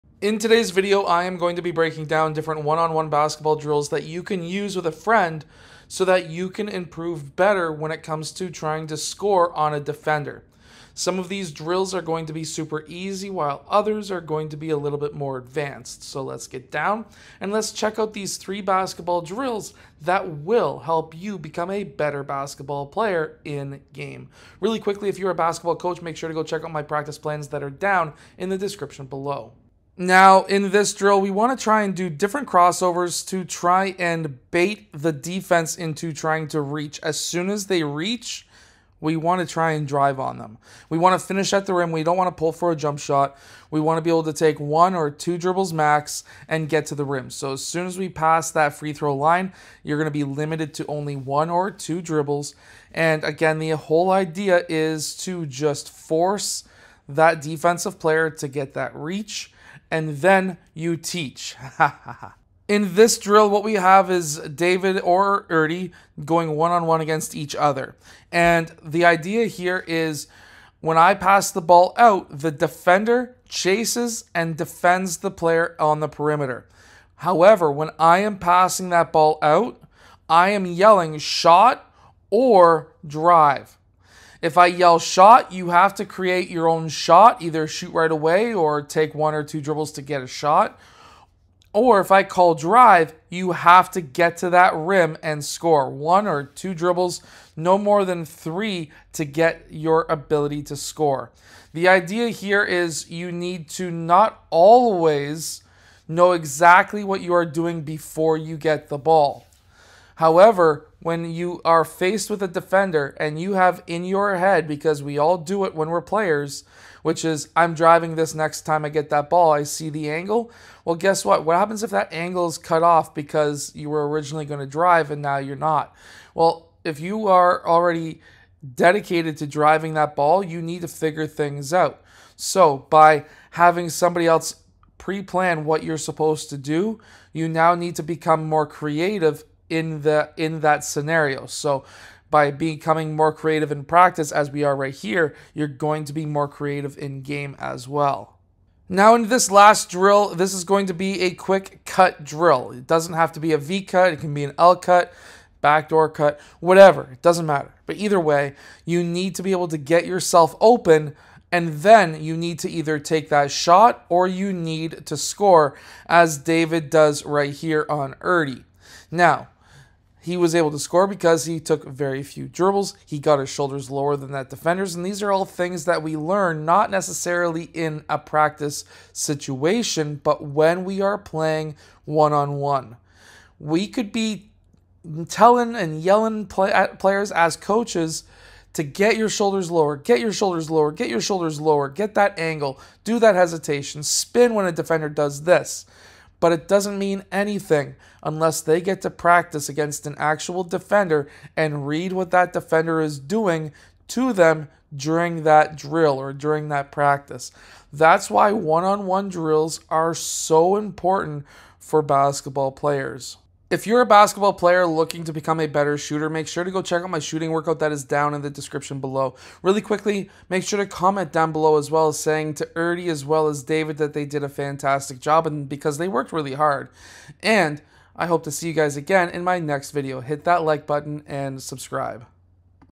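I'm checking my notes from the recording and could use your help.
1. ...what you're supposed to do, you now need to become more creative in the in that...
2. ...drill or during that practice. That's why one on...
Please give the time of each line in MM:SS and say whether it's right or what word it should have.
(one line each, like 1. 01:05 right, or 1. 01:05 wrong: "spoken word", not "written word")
1. 02:15 right
2. 03:25 right.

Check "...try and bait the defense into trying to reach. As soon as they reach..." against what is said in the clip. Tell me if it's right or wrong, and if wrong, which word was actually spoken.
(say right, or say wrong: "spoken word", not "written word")
right.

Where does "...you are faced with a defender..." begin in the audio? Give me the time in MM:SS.
01:51.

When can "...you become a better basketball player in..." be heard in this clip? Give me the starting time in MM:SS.
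00:21.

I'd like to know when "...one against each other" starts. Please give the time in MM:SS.
01:06.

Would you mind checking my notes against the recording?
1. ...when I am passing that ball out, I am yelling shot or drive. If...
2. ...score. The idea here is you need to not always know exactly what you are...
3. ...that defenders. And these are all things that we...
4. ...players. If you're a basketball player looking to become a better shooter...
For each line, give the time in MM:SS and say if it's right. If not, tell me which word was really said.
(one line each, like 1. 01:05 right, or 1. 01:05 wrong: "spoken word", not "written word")
1. 01:17 right
2. 01:40 right
3. 02:54 right
4. 03:32 right.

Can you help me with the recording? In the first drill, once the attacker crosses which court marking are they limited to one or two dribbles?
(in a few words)
free throw line.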